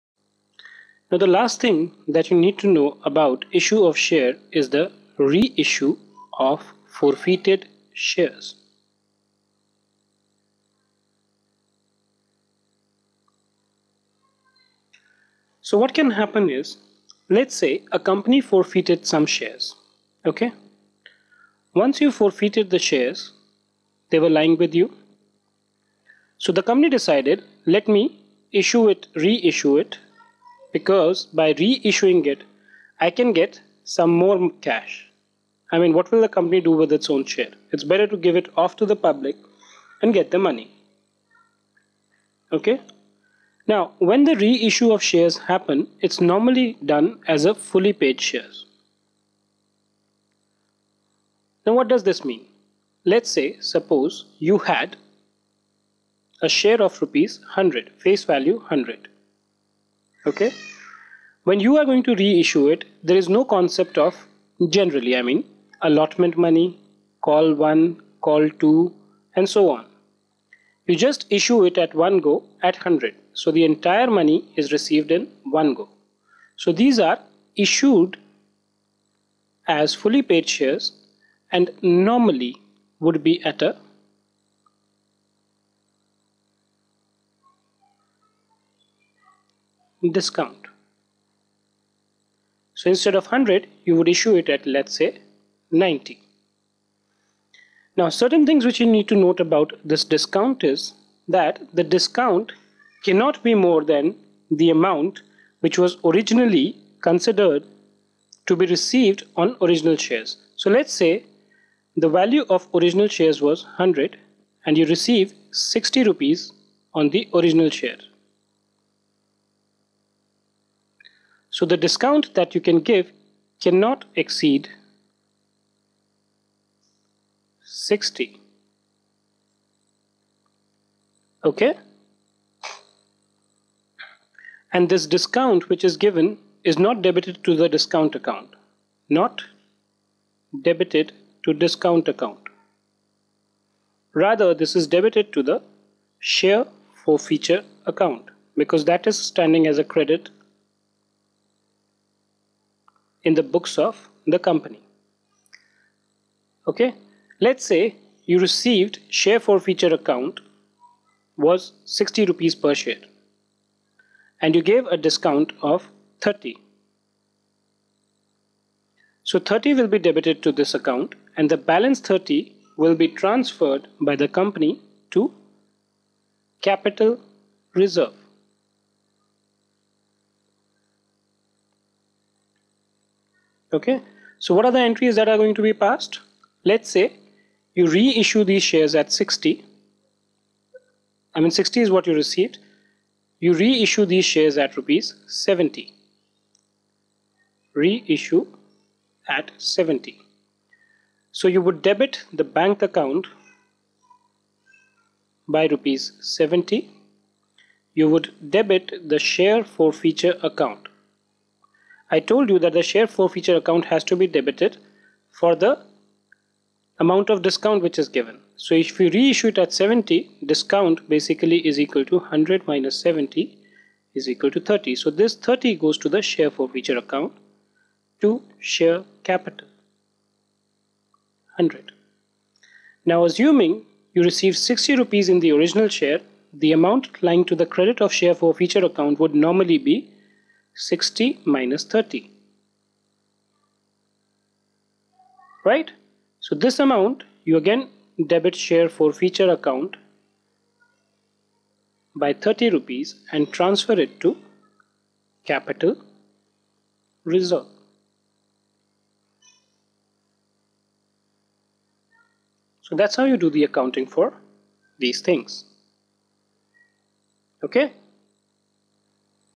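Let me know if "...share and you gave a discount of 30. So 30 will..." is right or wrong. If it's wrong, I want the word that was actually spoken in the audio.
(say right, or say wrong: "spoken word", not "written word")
right.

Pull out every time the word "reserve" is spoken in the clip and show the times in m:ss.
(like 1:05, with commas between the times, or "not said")
2:57, 4:17.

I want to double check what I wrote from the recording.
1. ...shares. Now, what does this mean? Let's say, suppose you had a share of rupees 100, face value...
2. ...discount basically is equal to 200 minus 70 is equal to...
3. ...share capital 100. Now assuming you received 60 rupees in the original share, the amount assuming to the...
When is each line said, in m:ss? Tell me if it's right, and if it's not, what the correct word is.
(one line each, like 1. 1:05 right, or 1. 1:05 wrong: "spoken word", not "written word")
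1. 0:48 right
2. 3:40 wrong: "100", not "200"
3. 3:48 wrong: "lying", not "assuming".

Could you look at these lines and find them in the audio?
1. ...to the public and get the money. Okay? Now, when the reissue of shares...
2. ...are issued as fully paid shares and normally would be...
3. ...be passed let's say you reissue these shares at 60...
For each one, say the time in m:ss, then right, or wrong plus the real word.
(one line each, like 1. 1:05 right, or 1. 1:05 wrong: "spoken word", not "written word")
1. 0:38 right
2. 1:17 right
3. 3:05 right.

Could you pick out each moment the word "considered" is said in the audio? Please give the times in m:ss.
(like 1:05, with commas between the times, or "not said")
1:47.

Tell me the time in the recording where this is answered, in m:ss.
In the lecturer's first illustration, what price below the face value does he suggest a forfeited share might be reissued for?
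1:35.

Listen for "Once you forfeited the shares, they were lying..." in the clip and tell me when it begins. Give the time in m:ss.
0:21.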